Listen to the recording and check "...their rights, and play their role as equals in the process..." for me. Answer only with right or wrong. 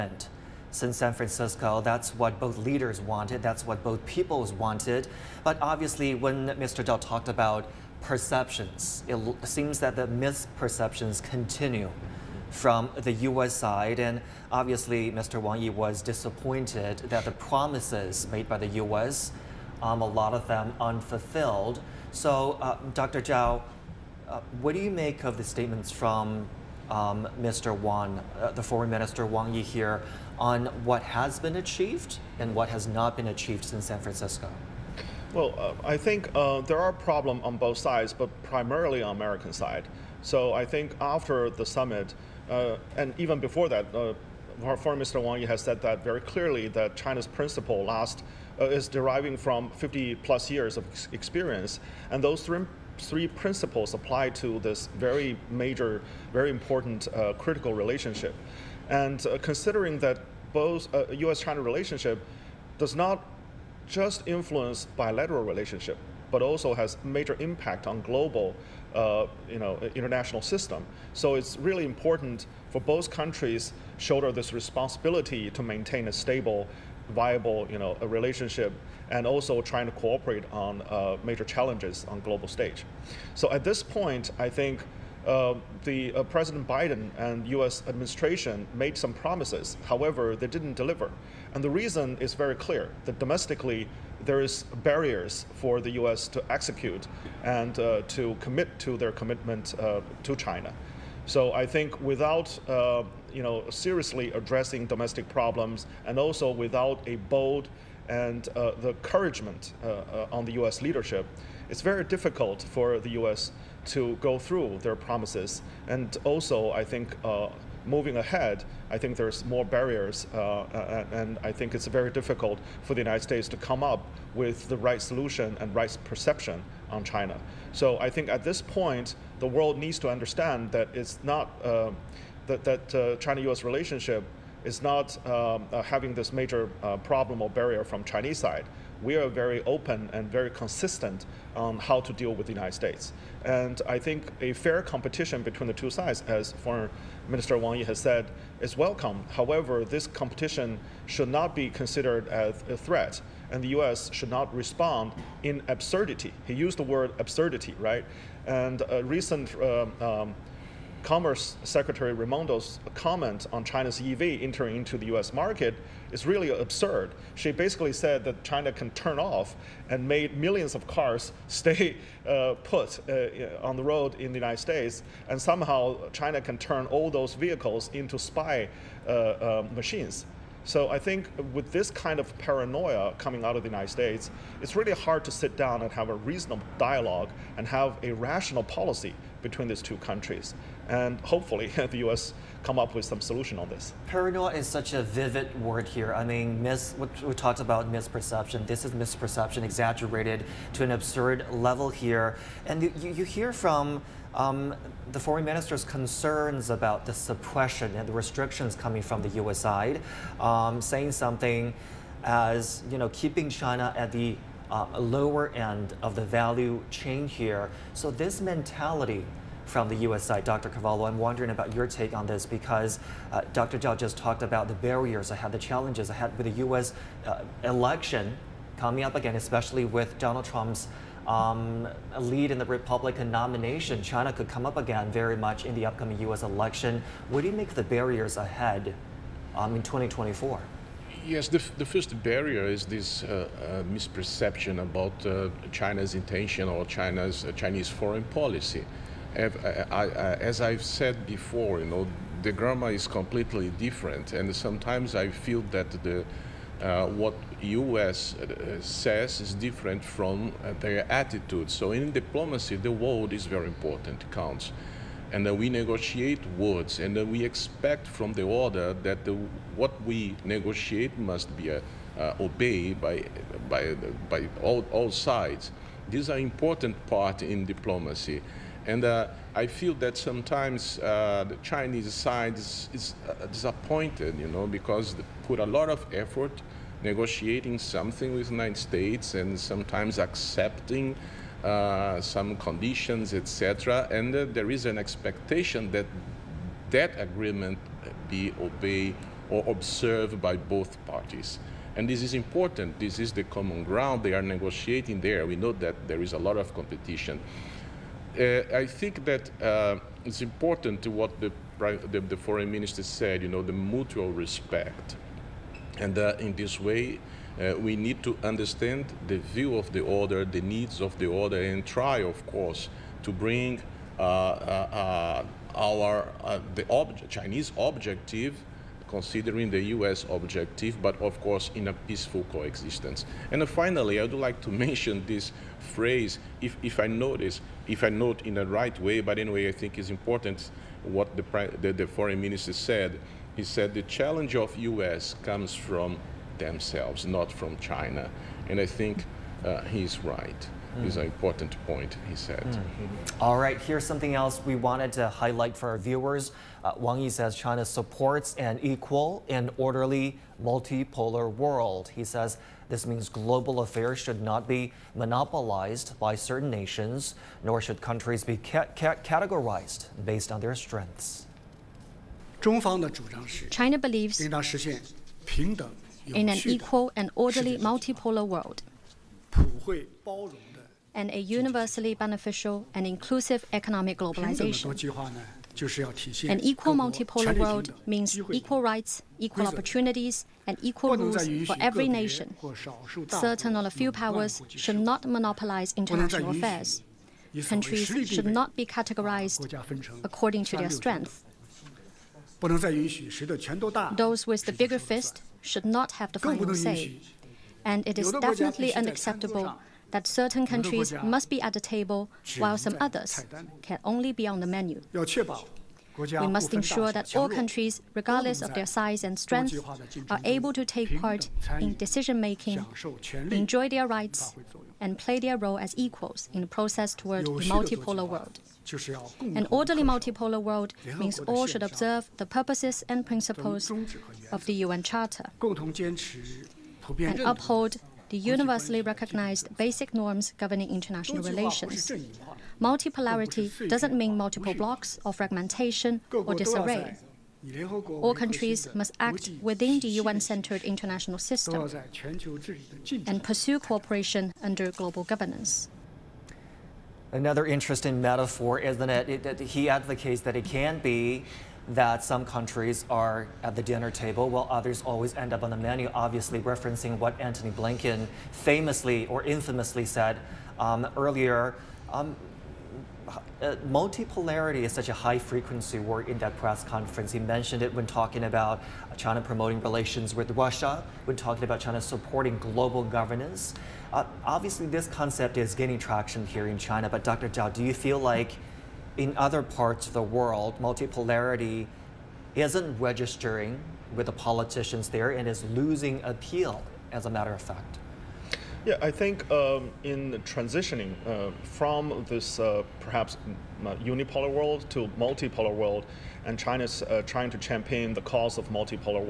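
right.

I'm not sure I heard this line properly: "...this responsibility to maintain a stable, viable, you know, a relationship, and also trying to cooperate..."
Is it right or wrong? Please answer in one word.
right.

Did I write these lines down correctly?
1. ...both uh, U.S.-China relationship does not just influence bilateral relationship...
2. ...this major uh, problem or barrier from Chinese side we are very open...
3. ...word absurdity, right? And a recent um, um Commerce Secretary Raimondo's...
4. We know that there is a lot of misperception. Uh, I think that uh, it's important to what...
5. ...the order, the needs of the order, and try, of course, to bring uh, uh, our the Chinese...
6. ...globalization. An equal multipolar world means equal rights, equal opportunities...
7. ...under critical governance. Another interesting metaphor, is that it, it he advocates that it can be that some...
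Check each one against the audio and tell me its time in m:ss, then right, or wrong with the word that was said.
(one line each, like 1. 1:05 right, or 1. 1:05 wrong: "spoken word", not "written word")
1. 1:00 right
2. 2:16 right
3. 2:36 right
4. 5:05 wrong: "competition", not "misperception"
5. 5:19 right
6. 6:24 right
7. 7:34 wrong: "global", not "critical".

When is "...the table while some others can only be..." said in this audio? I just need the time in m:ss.
6:51.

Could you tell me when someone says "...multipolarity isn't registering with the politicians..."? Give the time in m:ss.
8:10.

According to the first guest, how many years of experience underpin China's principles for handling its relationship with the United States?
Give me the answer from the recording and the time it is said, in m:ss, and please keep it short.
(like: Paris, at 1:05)
50 plus years, at 0:49.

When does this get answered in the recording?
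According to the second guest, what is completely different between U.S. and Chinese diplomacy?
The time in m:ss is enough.
4:12.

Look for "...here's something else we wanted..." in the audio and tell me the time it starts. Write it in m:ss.
5:53.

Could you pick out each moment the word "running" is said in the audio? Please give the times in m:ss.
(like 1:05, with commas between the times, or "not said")
not said.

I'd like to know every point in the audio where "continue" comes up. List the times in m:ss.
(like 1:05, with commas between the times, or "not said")
0:11.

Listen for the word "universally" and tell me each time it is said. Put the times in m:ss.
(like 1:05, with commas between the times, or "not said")
6:21, 7:18.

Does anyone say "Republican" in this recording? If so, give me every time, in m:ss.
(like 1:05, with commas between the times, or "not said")
3:52.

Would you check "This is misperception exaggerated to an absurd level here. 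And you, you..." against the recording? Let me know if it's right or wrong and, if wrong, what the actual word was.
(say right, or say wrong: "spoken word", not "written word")
right.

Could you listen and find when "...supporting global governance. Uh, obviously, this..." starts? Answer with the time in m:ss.
8:02.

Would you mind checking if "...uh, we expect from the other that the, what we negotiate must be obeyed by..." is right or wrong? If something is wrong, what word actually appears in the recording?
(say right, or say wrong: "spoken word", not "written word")
right.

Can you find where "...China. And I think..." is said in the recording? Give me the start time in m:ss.
5:47.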